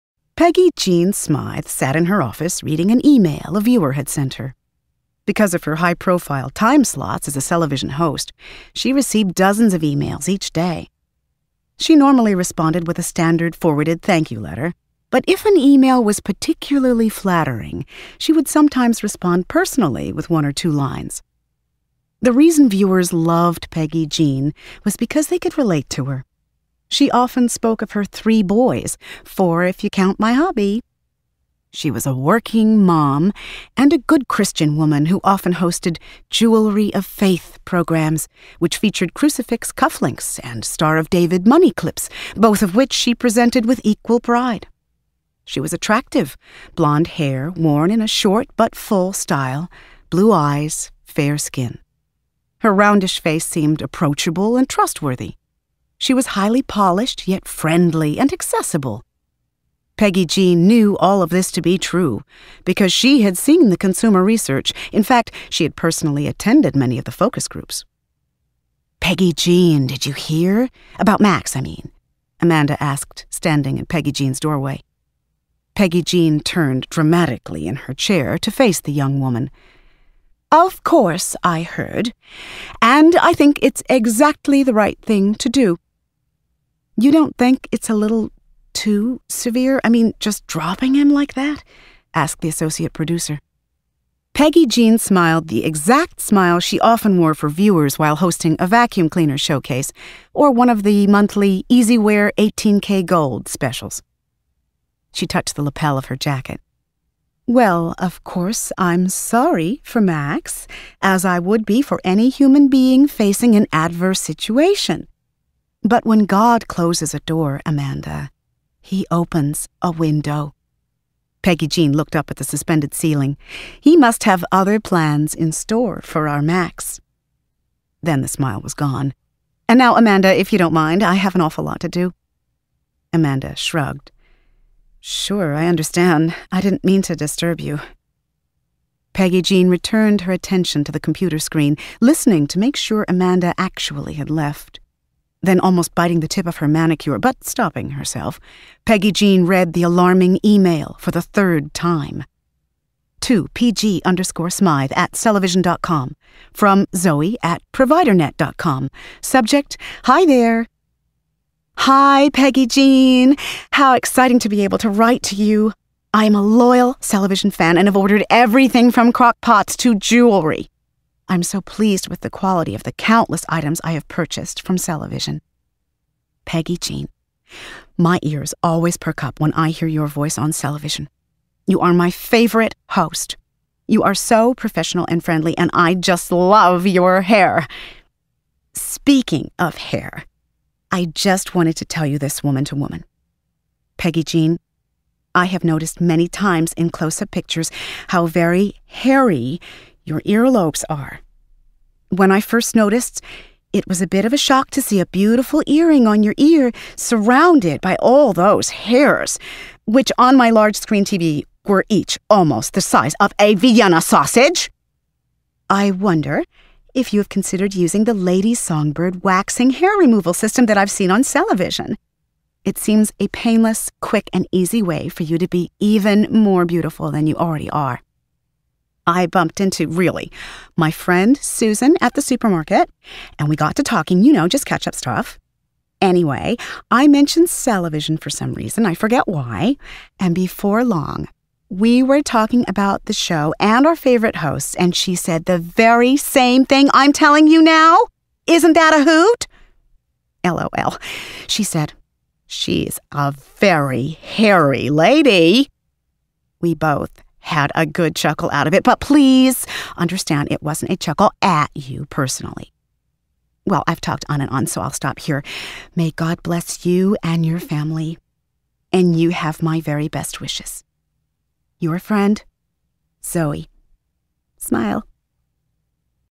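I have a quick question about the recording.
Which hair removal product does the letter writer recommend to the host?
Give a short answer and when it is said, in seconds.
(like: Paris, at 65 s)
Lady Songbird, at 218 s.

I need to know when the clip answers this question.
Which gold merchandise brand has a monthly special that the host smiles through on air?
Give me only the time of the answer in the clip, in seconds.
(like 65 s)
101 s.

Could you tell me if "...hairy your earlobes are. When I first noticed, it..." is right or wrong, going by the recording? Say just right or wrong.
right.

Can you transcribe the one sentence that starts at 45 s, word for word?
She was attractive, blonde hair worn in a short but full style, blue eyes, fair skin.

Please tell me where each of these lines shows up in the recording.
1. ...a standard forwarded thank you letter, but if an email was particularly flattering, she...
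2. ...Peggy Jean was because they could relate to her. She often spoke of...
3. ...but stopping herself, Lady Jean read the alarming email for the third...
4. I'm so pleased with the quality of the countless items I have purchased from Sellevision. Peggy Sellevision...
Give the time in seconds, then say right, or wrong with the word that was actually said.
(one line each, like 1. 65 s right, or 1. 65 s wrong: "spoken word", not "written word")
1. 12 s right
2. 23 s right
3. 147 s wrong: "Peggy", not "Lady"
4. 171 s wrong: "Jean", not "Sellevision".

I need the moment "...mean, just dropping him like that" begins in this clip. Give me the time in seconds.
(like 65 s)
89 s.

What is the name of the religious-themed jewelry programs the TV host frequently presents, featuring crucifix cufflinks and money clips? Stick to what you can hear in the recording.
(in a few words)
Jewelry of Faith.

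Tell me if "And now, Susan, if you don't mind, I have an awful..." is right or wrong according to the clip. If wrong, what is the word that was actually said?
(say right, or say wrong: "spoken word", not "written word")
wrong: "Amanda", not "Susan".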